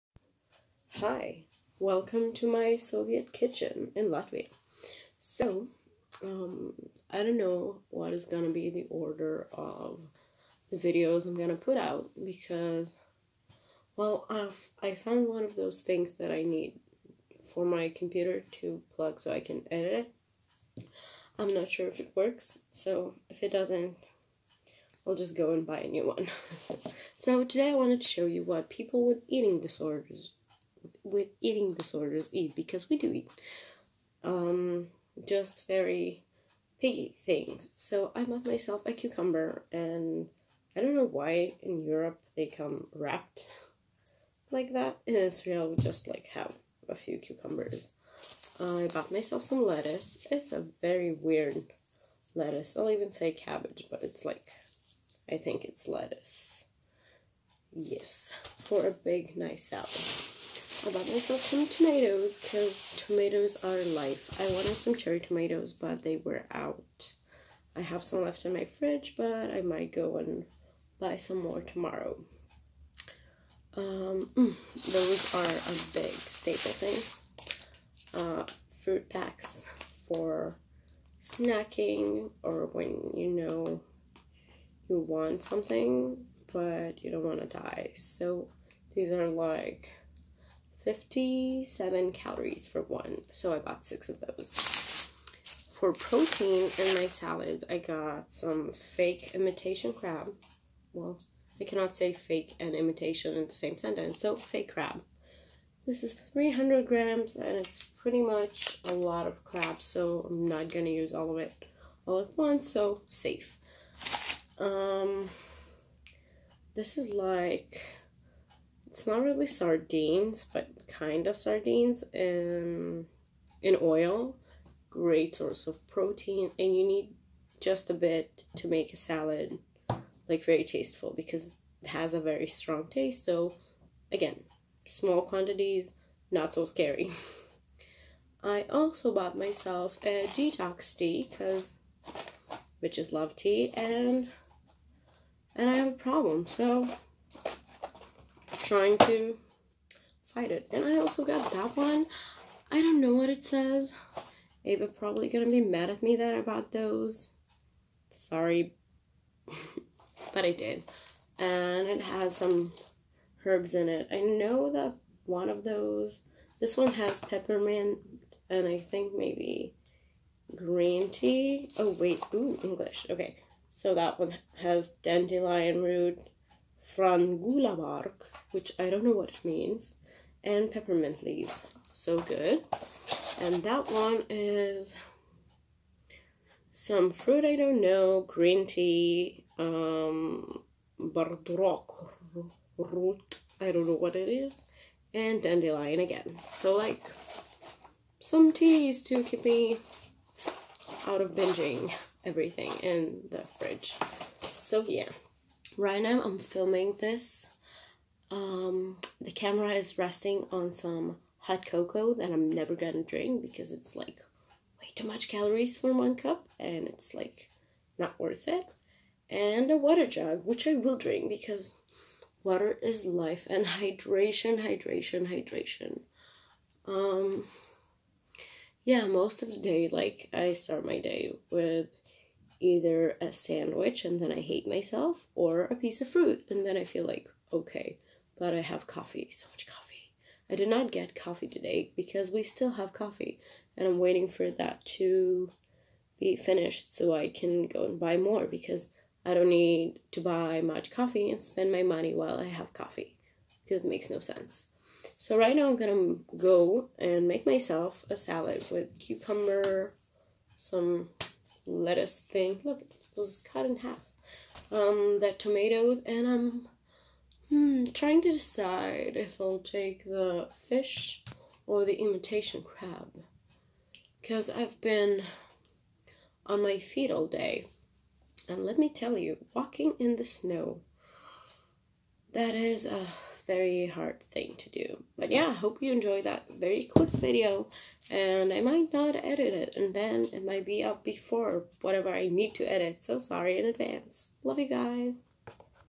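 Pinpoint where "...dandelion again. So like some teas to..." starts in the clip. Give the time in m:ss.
3:15.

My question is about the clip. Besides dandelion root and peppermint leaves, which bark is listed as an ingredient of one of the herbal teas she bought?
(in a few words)
frangula bark.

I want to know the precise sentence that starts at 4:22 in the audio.
Look, it was cut in half.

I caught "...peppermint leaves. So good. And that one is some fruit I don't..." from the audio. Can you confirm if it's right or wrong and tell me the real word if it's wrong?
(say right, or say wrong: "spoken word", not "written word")
right.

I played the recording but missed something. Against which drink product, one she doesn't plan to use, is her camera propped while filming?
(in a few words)
hot cocoa.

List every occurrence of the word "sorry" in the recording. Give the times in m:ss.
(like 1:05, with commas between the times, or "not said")
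2:38, 4:53.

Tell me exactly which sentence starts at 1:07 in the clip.
I have some left in my fridge, but I might go and buy some more tomorrow.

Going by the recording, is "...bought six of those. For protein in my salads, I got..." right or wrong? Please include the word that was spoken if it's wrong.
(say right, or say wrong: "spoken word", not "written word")
right.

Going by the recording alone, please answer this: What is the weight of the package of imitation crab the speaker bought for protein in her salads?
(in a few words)
300 grams.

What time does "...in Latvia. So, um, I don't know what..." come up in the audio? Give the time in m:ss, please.
0:03.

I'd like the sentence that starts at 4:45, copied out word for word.
But yeah, hope you enjoy that very quick video.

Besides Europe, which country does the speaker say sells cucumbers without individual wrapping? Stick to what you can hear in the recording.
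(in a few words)
Israel.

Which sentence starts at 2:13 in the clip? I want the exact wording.
So, again, small quantities, not so scary.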